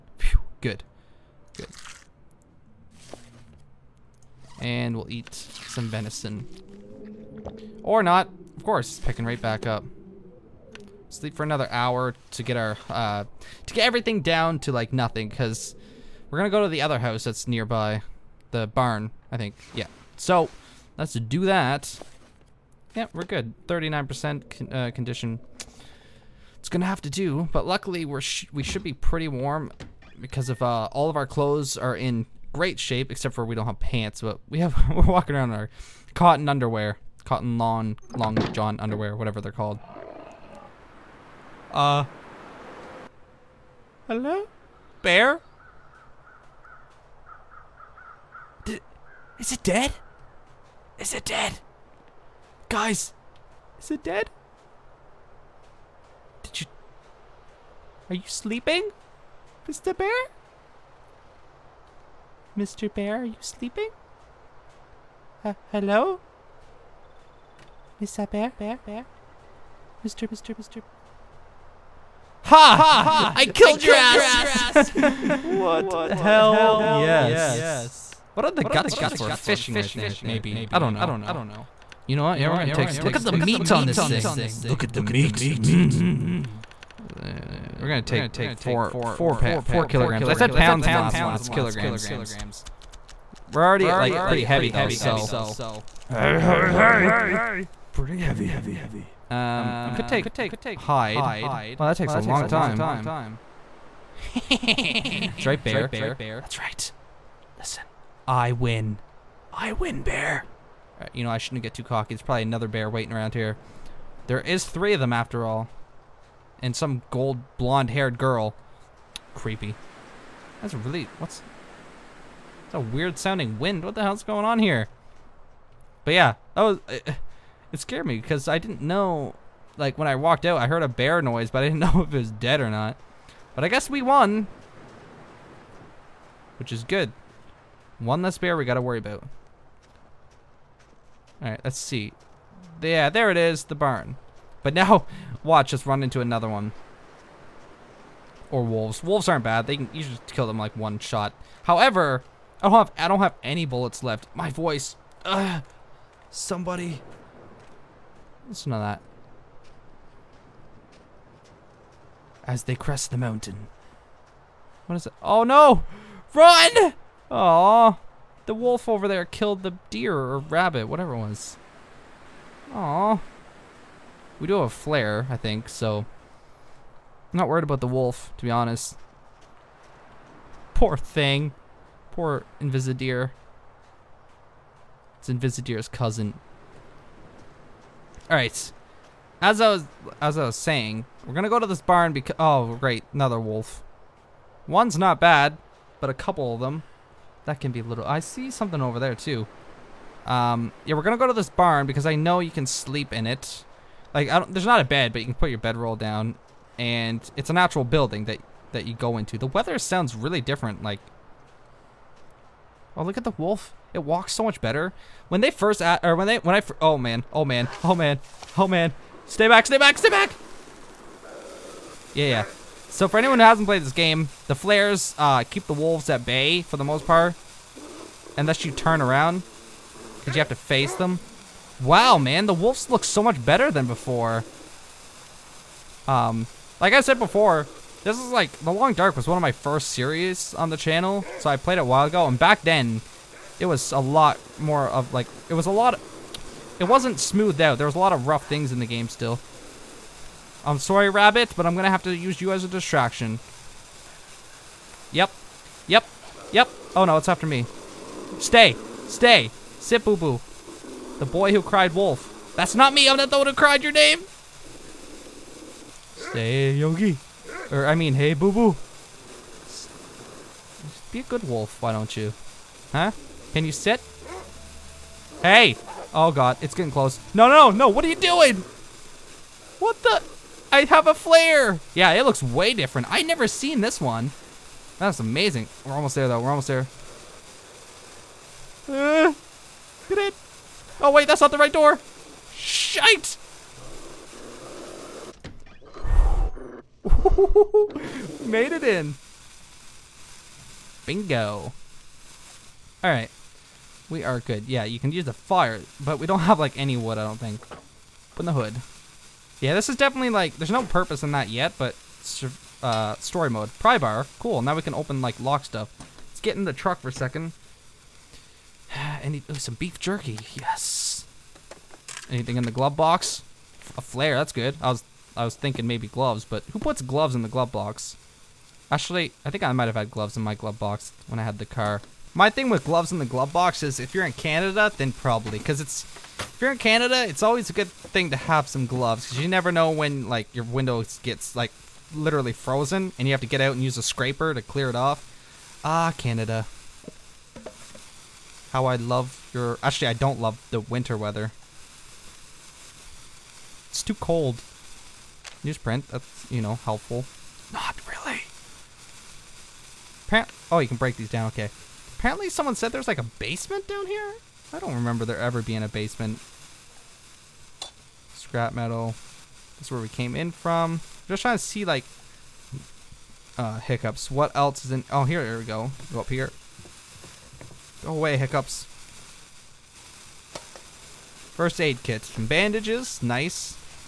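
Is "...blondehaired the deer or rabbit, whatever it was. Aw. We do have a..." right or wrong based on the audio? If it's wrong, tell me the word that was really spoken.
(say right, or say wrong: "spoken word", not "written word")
wrong: "killed", not "blondehaired".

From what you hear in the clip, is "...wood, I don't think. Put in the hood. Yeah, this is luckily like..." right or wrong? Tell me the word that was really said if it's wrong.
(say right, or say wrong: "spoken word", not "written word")
wrong: "definitely", not "luckily".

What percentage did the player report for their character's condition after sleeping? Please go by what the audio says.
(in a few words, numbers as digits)
39%.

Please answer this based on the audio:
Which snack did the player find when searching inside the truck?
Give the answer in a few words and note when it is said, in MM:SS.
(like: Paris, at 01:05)
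Beef jerky, at 05:19.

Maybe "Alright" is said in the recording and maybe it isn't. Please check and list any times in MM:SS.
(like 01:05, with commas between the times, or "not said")
02:21, 03:08.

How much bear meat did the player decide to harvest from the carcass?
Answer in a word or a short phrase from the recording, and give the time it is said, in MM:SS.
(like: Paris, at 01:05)
4 kilograms, at 01:29.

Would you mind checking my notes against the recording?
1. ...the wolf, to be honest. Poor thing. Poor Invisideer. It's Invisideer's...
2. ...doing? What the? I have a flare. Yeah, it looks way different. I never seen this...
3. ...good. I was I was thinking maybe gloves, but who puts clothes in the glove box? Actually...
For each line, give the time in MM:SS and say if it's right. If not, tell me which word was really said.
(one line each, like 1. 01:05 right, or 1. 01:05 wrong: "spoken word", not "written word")
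1. 02:57 right
2. 04:38 right
3. 05:24 wrong: "gloves", not "clothes".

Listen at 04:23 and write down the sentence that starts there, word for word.
I'm not the one who cried your name.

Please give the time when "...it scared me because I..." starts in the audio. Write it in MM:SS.
02:07.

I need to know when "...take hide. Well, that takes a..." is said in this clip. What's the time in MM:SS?
01:40.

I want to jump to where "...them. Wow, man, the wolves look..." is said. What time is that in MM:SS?
03:50.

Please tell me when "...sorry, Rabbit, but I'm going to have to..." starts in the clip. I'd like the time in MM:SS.
04:10.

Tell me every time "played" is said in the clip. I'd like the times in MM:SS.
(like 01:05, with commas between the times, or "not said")
03:43, 04:01.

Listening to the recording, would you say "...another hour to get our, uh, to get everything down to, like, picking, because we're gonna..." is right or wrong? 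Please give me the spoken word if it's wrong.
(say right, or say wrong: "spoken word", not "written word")
wrong: "nothing", not "picking".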